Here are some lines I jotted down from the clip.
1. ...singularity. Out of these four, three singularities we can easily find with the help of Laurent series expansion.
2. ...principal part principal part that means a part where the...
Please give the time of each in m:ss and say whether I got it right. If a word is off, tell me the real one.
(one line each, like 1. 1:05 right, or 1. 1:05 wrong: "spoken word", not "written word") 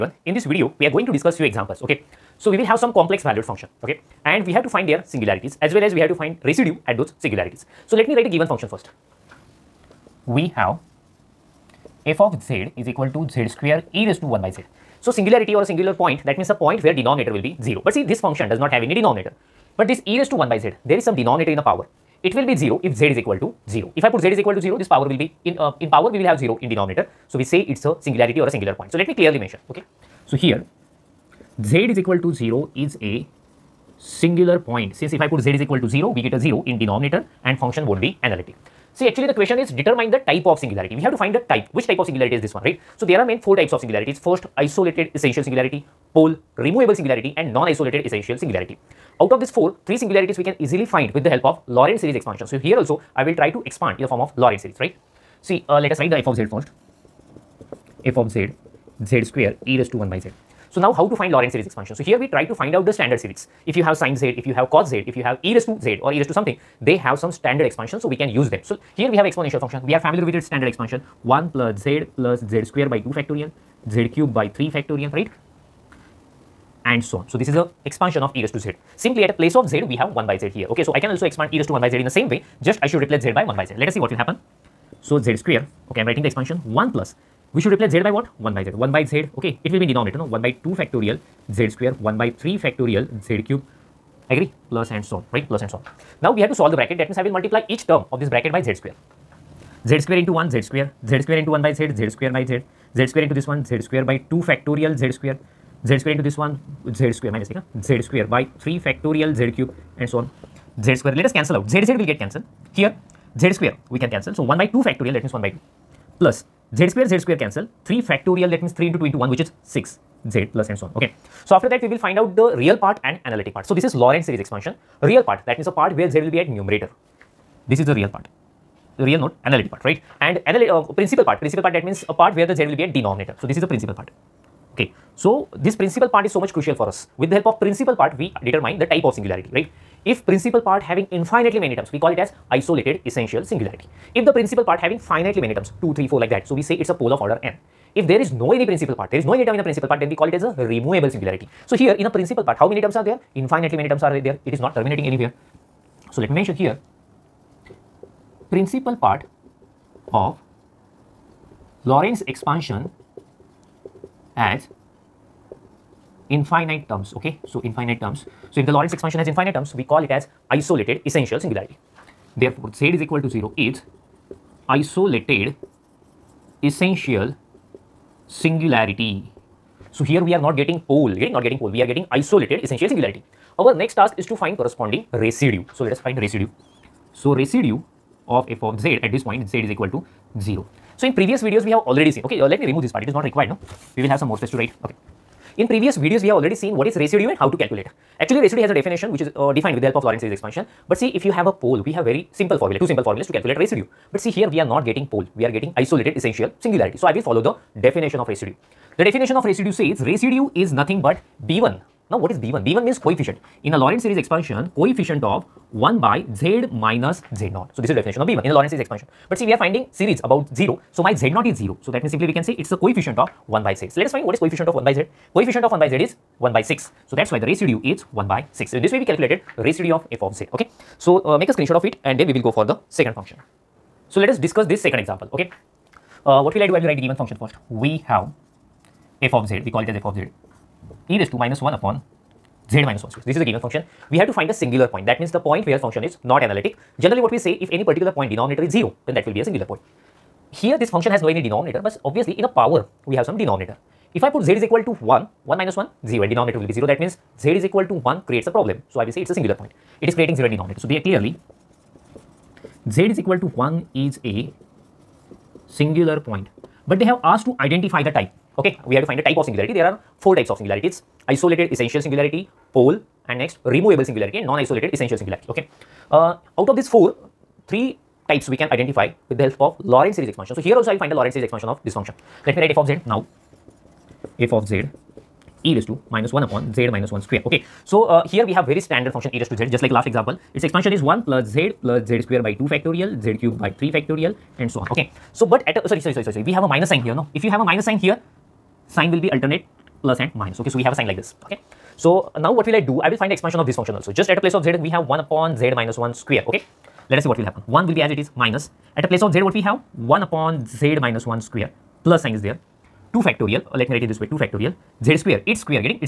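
1. 0:48 right
2. 2:10 right.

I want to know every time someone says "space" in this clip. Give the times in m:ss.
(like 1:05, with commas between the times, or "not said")
3:14, 4:03.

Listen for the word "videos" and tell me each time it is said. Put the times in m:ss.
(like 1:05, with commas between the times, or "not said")
0:00, 3:11, 3:15.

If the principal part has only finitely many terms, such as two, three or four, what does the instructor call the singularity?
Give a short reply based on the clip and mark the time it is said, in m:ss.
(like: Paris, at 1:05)
A pole of order n, at 2:26.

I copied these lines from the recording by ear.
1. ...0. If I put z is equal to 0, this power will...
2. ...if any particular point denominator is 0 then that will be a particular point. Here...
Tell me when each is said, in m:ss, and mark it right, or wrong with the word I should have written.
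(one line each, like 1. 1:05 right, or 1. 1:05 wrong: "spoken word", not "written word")
1. 0:23 right
2. 4:07 wrong: "singular", not "particular".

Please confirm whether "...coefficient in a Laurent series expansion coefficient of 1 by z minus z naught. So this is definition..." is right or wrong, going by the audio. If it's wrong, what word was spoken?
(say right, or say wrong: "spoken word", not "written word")
right.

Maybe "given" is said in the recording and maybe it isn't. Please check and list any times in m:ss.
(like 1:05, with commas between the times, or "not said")
0:08, 3:56, 4:03.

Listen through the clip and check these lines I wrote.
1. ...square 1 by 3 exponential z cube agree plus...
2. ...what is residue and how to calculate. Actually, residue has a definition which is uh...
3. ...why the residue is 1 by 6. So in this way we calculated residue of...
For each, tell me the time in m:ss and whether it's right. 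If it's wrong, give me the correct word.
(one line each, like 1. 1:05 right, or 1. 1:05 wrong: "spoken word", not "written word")
1. 1:31 wrong: "factorial", not "exponential"
2. 3:16 right
3. 3:47 right.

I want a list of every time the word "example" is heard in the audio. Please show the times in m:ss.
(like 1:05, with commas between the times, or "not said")
0:01, 3:54, 4:50.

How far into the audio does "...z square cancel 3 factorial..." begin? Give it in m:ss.
1:57.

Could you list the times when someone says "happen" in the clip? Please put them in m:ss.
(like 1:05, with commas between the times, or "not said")
1:24, 5:07.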